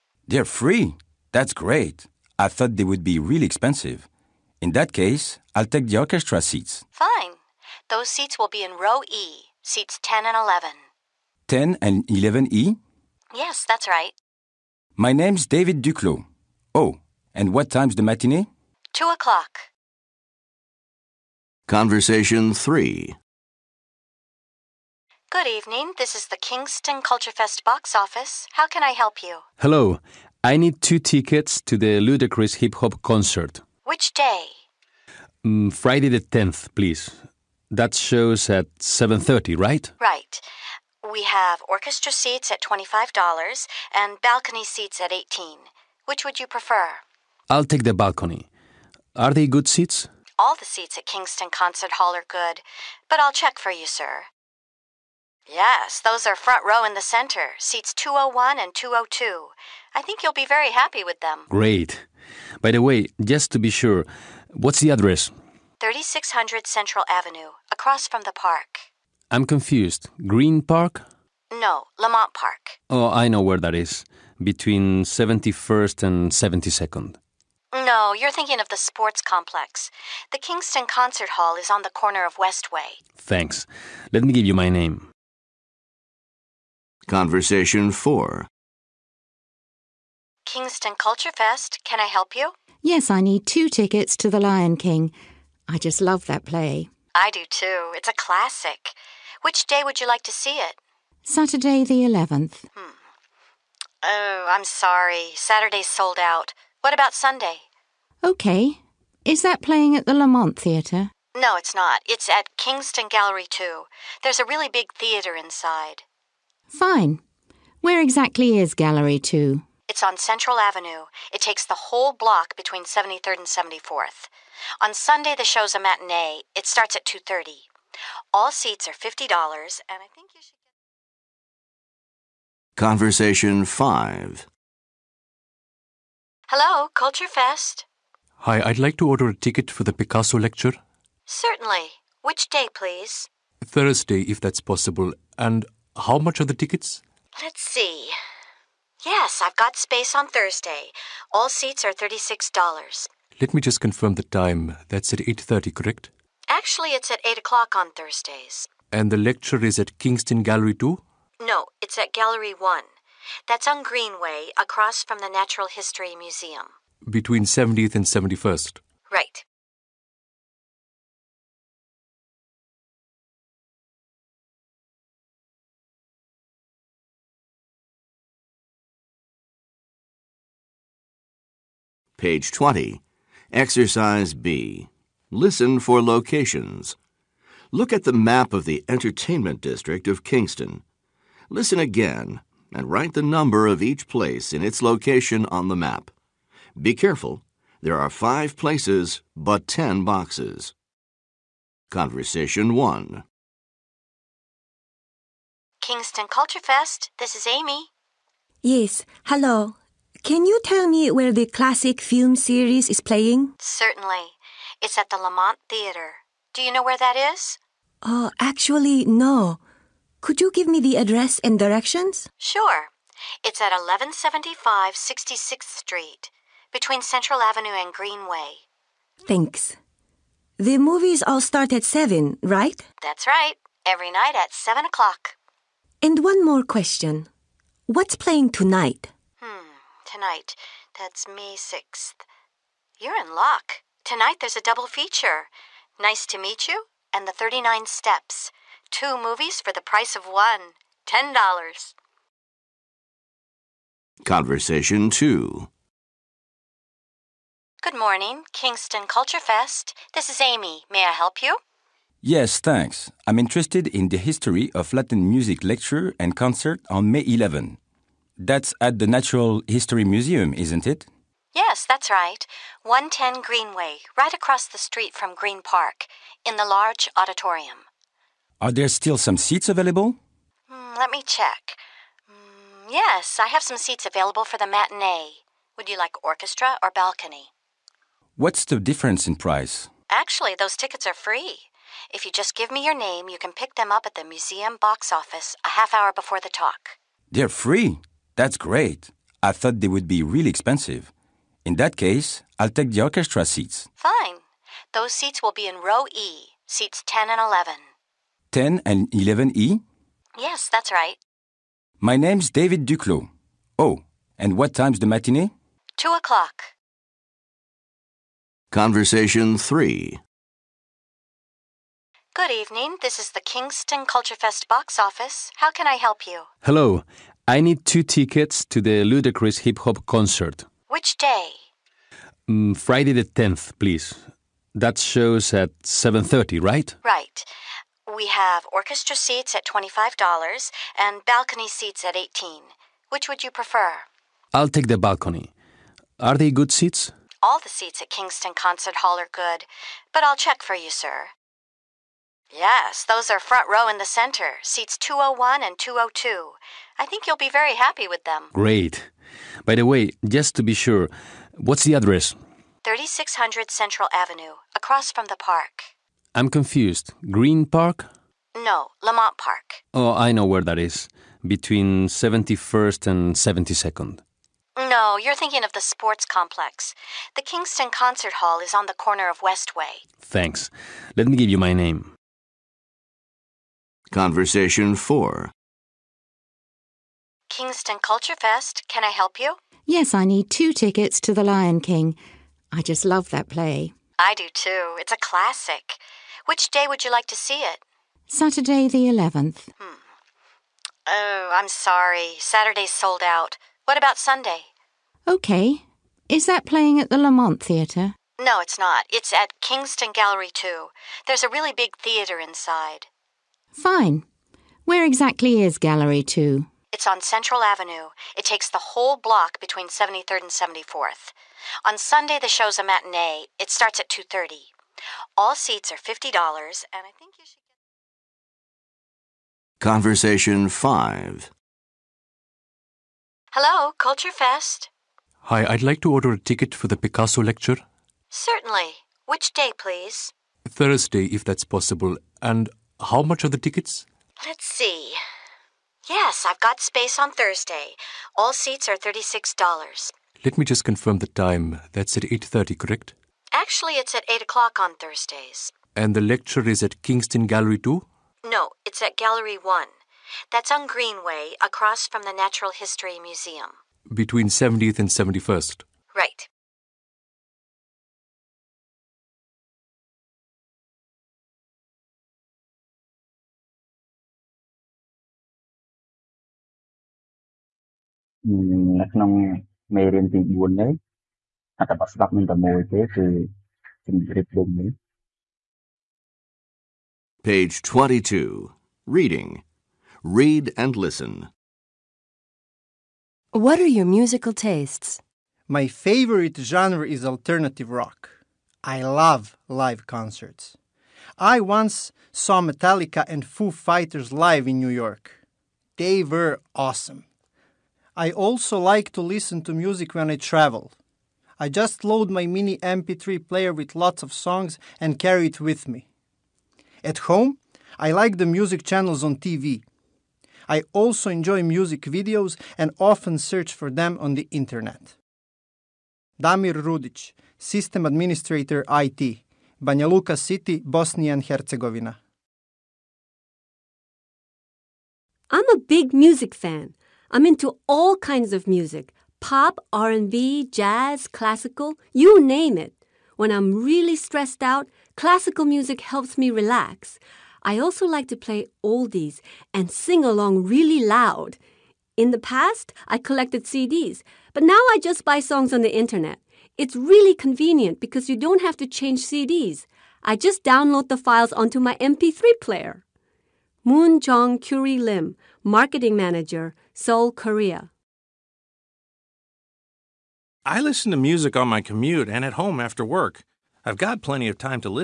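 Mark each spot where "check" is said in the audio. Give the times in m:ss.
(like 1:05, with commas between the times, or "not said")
0:53, 4:41, 5:50.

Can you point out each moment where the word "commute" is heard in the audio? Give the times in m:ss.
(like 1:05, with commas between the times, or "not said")
9:31.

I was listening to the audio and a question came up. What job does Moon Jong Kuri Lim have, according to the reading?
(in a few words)
Marketing Manager.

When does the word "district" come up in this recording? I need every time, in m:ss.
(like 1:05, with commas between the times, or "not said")
3:09.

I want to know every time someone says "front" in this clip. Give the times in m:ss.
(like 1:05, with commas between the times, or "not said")
0:56, 5:53.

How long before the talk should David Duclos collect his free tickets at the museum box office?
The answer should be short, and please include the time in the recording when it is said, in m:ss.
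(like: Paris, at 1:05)
a half hour, at 4:55.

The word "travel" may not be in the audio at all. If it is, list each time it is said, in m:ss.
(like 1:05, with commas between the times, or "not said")
8:30.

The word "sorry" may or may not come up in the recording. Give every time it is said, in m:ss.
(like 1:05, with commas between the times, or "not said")
1:44, 6:41.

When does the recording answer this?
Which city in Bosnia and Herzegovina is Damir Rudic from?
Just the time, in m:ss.
8:49.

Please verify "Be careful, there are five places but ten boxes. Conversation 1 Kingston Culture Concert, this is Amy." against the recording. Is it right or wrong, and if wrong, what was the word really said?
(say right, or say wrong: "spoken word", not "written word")
wrong: "Fest", not "Concert".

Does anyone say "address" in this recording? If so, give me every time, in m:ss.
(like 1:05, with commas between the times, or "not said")
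1:04, 3:40, 6:01.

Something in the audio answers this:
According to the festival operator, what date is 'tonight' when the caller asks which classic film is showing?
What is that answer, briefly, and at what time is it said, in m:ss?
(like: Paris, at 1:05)
May 6, at 4:01.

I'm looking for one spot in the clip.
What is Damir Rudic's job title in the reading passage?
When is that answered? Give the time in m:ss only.
8:47.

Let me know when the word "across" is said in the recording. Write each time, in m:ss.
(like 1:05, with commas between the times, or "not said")
1:07, 2:44, 4:34, 6:04, 7:41.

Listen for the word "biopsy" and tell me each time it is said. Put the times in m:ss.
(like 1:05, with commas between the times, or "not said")
not said.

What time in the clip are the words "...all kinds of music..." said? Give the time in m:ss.
8:57.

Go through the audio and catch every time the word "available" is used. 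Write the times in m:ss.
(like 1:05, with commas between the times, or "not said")
4:39, 4:44.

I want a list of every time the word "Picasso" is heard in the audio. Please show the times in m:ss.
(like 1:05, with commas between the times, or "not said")
2:19, 7:16.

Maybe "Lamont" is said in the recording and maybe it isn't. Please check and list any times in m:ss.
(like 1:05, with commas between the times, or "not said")
1:11, 1:50, 3:35, 6:09, 6:47.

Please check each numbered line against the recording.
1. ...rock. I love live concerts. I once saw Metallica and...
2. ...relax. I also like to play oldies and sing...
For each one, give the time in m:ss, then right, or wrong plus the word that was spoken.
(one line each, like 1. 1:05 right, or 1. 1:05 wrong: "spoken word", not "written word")
1. 8:17 right
2. 9:06 right.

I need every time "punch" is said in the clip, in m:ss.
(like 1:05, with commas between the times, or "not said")
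not said.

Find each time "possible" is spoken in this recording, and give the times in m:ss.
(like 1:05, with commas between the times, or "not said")
2:24, 7:21.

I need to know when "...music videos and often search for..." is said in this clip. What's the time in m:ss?
8:41.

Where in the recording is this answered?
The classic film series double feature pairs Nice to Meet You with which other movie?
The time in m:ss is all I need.
4:07.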